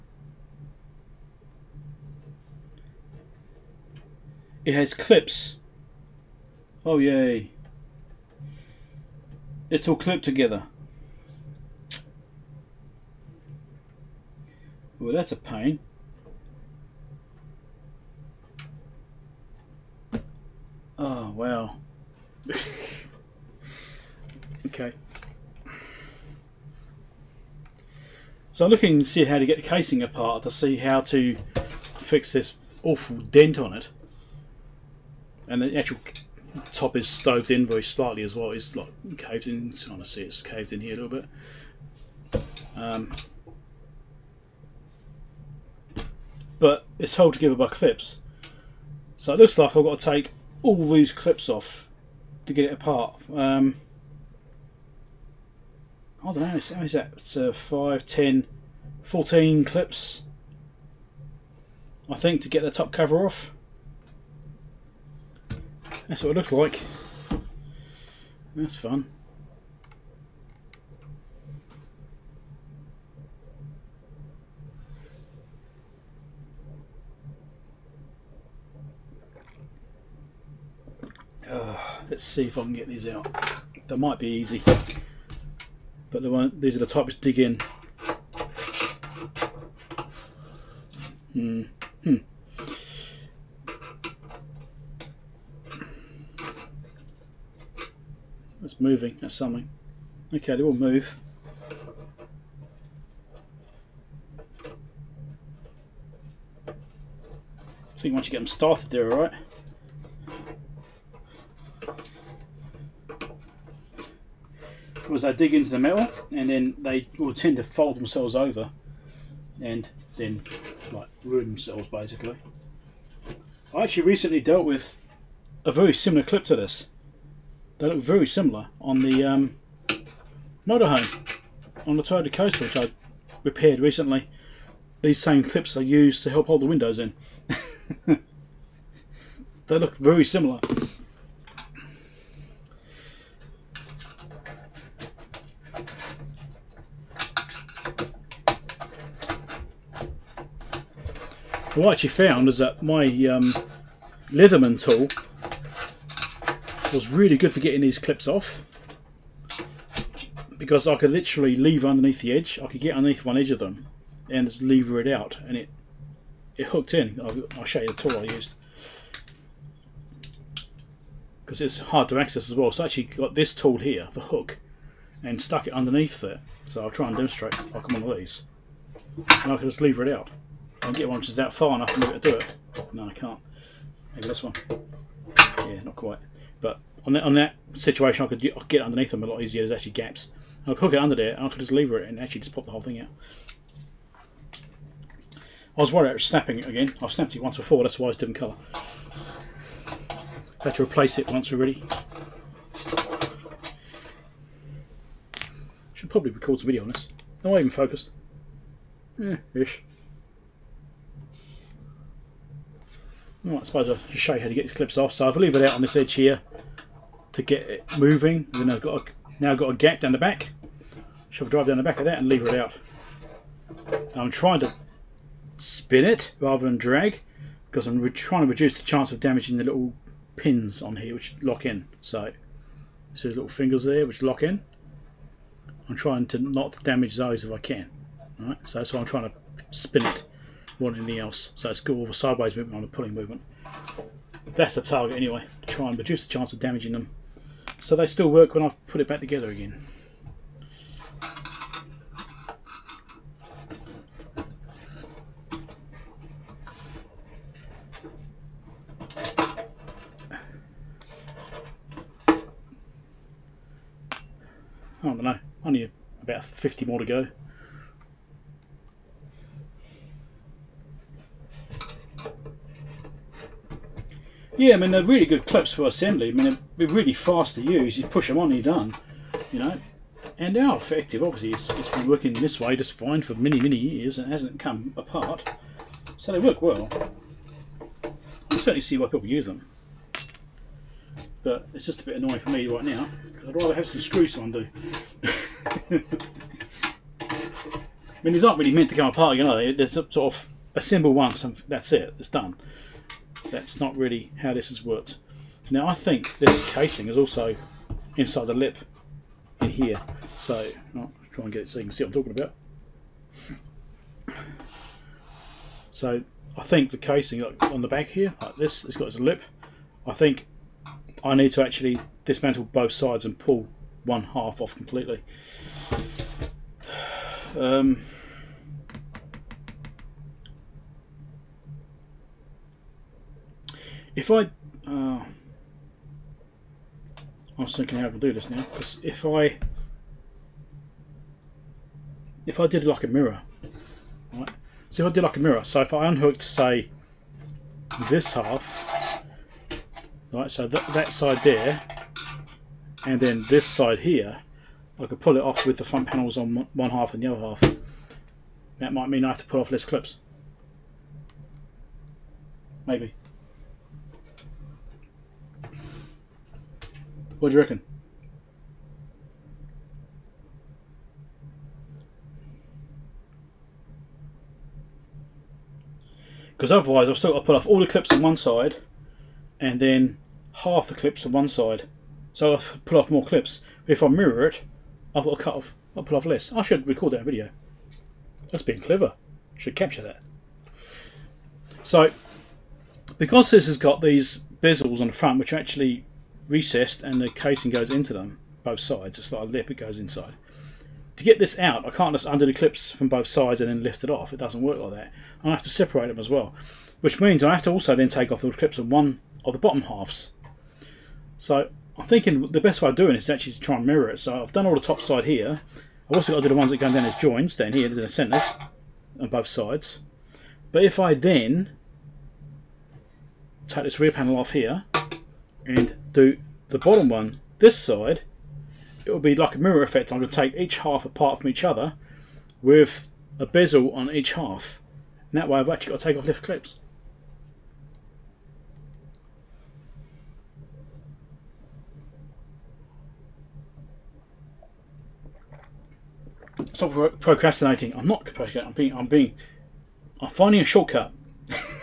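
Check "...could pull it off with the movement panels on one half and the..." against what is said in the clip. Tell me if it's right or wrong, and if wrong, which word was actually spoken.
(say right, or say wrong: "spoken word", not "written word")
wrong: "front", not "movement".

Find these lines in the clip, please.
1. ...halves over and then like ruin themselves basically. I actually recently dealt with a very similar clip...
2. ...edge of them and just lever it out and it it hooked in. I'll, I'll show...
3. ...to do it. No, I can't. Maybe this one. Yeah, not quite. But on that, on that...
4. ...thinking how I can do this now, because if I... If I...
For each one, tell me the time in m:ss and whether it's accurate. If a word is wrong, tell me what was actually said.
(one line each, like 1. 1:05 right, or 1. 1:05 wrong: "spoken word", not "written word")
1. 1:57 wrong: "themselves", not "halves"
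2. 2:43 right
3. 3:01 right
4. 5:37 right.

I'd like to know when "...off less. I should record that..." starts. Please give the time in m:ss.
6:26.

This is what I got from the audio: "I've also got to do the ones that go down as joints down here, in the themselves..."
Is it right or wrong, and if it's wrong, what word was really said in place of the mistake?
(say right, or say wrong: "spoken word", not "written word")
wrong: "centres", not "themselves".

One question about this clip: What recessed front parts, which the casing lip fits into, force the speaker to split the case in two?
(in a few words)
bezels.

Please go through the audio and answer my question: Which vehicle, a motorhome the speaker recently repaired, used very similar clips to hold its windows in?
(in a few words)
Toyota Coaster.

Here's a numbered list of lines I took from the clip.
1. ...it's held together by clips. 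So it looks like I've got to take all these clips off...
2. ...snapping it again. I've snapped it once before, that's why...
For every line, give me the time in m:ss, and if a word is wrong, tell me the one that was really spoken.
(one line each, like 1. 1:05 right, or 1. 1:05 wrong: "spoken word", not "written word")
1. 0:46 right
2. 3:16 right.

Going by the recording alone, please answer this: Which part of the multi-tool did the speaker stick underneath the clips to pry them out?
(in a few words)
the hook.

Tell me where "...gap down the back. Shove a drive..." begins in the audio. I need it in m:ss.
3:39.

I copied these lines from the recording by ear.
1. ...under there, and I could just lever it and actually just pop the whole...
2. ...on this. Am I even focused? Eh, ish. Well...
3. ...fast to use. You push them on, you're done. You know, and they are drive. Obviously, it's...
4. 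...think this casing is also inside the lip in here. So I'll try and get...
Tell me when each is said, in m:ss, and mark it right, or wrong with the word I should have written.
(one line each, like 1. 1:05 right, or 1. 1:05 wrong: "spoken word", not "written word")
1. 3:10 right
2. 3:26 right
3. 4:37 wrong: "effective", not "drive"
4. 5:05 right.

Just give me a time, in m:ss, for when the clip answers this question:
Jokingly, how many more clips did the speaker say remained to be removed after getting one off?
4:26.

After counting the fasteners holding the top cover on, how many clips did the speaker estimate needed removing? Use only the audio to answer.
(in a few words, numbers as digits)
14.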